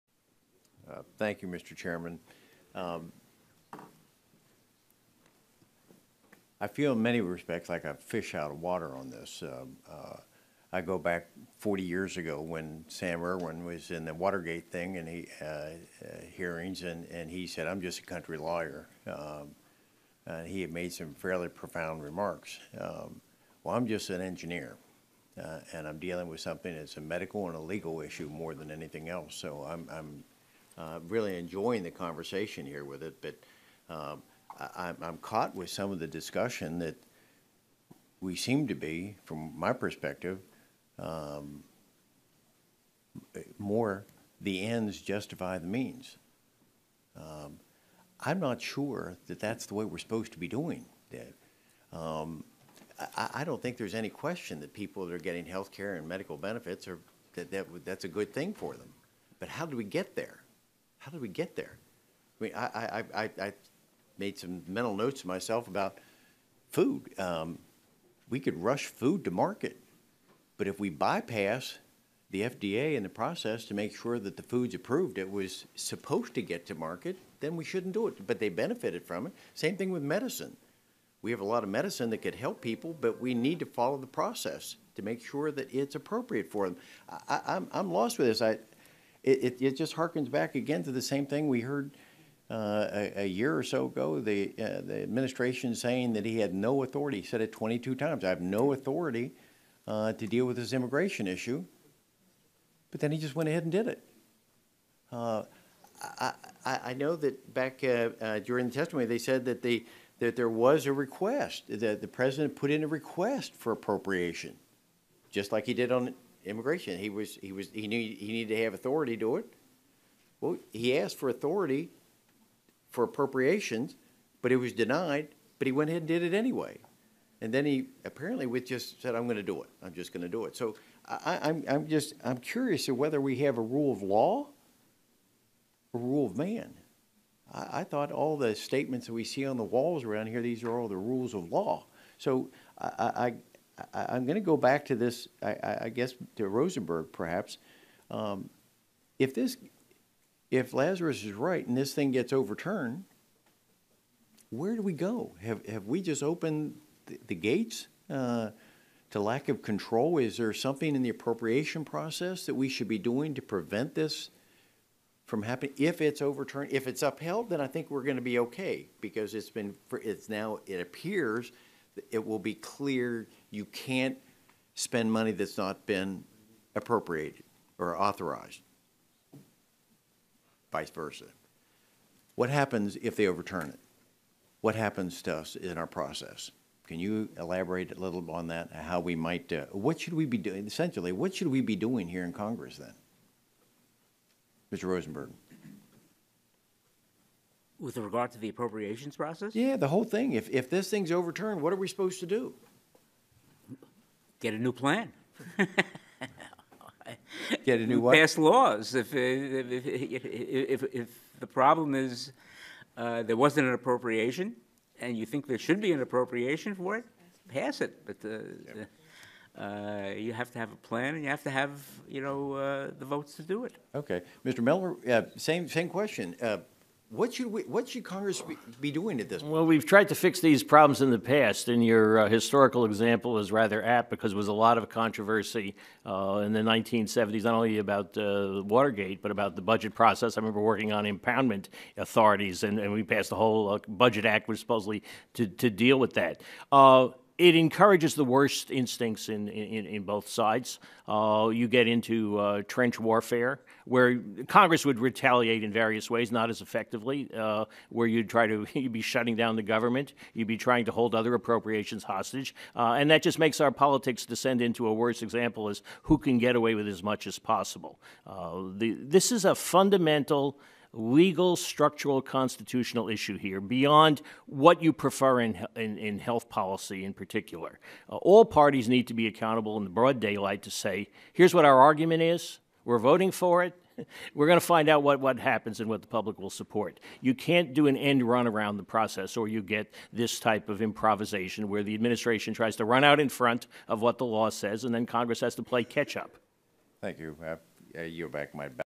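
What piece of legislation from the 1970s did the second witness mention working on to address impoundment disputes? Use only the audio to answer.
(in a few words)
Budget Act.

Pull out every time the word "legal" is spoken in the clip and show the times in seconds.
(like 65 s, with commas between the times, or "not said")
27 s, 270 s.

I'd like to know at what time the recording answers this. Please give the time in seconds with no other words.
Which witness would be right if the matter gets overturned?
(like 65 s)
150 s.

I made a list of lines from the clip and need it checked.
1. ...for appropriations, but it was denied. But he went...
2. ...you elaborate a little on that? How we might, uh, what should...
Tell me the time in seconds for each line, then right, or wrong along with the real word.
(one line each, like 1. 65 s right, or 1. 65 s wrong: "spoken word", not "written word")
1. 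122 s right
2. 186 s right.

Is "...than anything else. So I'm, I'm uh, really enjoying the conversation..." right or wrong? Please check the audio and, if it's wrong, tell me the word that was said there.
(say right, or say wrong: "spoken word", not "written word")
right.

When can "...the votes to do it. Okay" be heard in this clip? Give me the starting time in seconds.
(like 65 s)
222 s.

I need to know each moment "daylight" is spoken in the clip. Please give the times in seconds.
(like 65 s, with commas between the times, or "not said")
280 s.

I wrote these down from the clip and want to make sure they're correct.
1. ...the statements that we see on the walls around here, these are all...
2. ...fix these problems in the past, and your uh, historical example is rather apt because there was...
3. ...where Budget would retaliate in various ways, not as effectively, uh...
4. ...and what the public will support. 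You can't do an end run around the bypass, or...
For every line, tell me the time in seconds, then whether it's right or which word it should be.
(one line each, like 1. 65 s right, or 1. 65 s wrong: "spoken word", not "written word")
1. 138 s right
2. 230 s right
3. 253 s wrong: "Congress", not "Budget"
4. 285 s wrong: "process", not "bypass".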